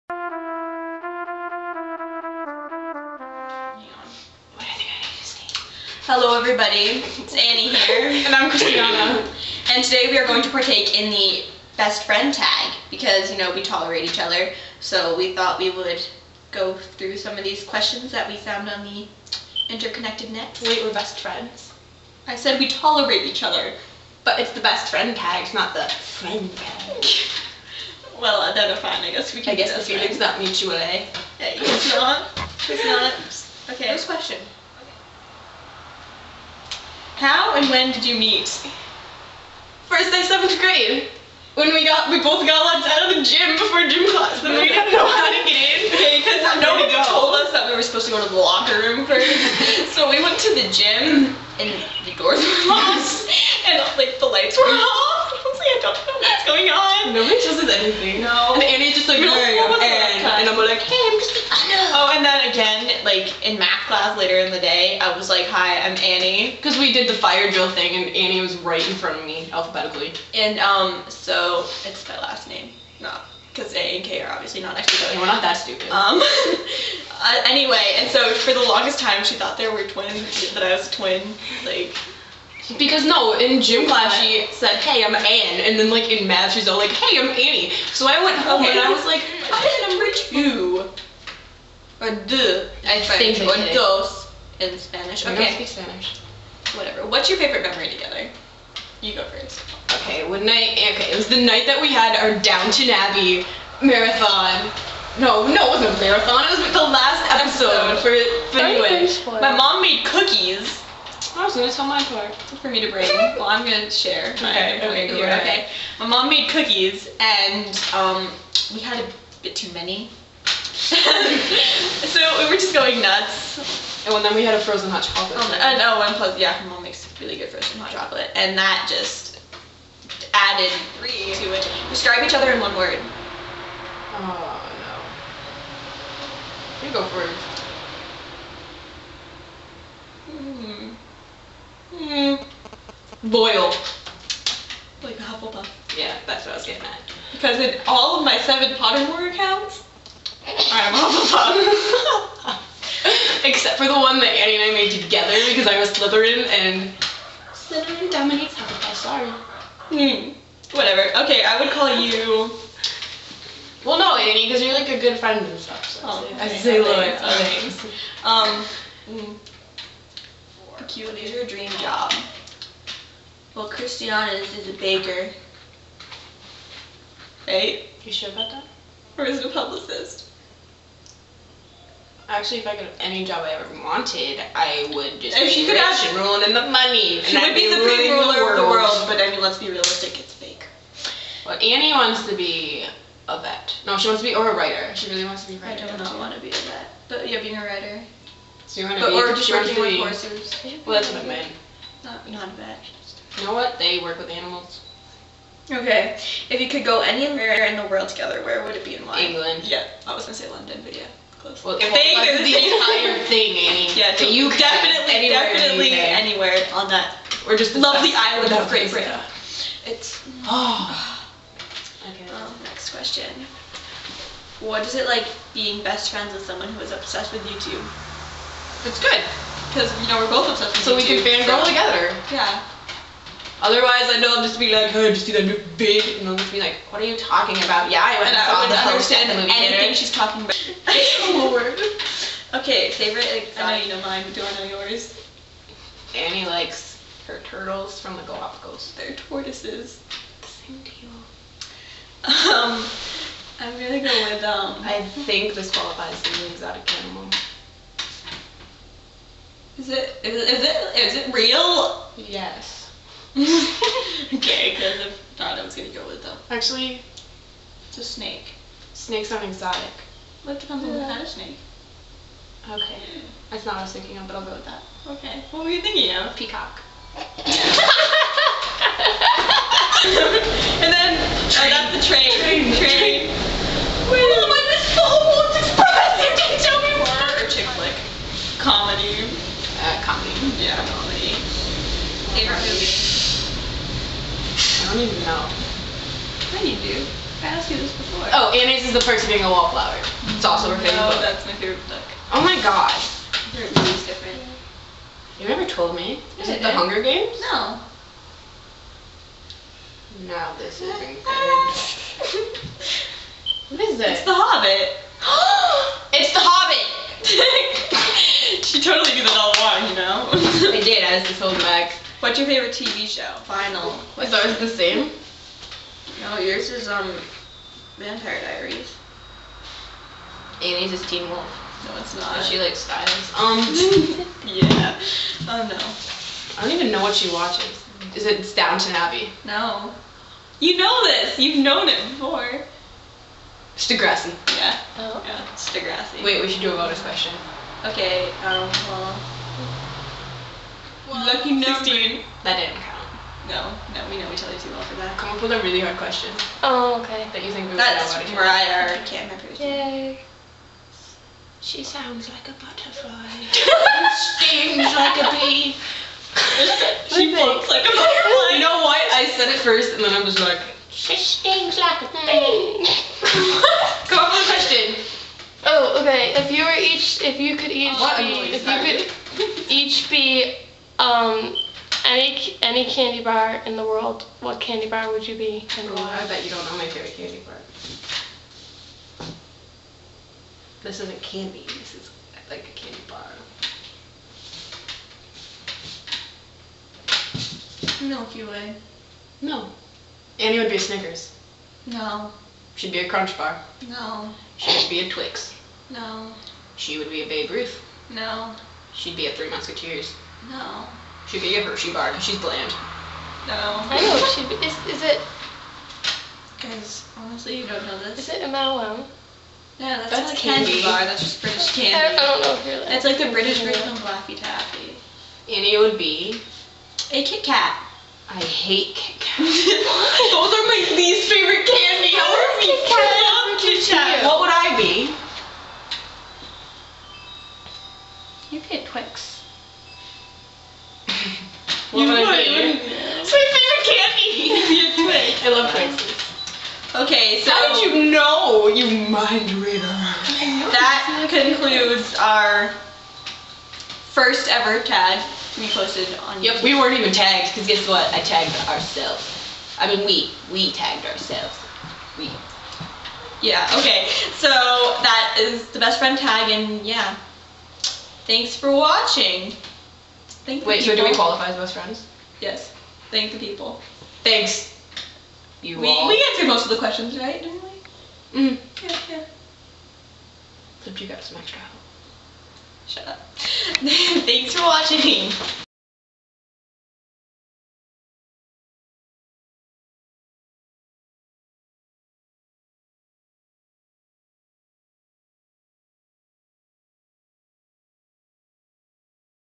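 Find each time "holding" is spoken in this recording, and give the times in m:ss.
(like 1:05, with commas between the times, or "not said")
5:21.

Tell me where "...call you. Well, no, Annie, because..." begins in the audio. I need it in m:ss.
2:41.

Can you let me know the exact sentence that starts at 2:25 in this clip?
Yeah, that's what I was getting at.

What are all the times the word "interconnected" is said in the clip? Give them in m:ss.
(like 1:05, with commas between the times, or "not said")
0:19.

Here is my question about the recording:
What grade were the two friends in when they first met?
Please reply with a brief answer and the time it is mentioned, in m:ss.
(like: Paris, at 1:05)
Seventh grade, at 0:40.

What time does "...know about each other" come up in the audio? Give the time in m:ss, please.
5:58.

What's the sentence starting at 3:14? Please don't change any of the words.
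She really wants to be a writer.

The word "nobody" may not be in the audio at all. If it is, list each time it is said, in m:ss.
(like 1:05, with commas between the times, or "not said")
0:46, 0:57.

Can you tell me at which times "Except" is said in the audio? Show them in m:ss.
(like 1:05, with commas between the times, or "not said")
2:33, 8:00.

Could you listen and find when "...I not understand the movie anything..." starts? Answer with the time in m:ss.
3:58.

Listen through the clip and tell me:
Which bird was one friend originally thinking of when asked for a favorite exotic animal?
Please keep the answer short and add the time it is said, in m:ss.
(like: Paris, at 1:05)
Peacock, at 4:36.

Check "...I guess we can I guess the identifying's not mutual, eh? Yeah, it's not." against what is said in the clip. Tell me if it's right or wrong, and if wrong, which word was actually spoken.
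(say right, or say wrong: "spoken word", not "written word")
wrong: "feeling", not "identifying".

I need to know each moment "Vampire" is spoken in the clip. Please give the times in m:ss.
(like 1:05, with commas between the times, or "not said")
5:27.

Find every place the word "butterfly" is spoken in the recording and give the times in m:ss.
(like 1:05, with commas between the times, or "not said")
6:02, 6:07.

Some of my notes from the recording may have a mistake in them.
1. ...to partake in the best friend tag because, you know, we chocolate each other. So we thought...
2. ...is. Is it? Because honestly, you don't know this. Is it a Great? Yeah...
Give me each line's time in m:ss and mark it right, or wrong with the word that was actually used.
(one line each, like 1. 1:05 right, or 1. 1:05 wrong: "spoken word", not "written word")
1. 0:10 wrong: "tolerate", not "chocolate"
2. 6:54 wrong: "MLM", not "Great".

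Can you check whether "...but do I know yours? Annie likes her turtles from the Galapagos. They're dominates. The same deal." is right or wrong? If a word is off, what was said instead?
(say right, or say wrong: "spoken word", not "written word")
wrong: "tortoises", not "dominates".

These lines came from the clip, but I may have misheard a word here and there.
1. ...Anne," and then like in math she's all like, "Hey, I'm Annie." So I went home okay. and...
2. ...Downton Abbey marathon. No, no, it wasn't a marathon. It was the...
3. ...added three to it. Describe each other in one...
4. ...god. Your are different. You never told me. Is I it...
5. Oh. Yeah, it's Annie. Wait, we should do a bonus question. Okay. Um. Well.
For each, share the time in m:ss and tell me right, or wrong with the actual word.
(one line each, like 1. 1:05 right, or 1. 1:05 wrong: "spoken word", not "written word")
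1. 1:25 right
2. 1:42 right
3. 2:10 right
4. 5:02 right
5. 5:44 wrong: "Degrassi", not "Annie".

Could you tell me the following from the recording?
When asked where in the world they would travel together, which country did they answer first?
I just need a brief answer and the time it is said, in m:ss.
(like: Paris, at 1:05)
England, at 3:29.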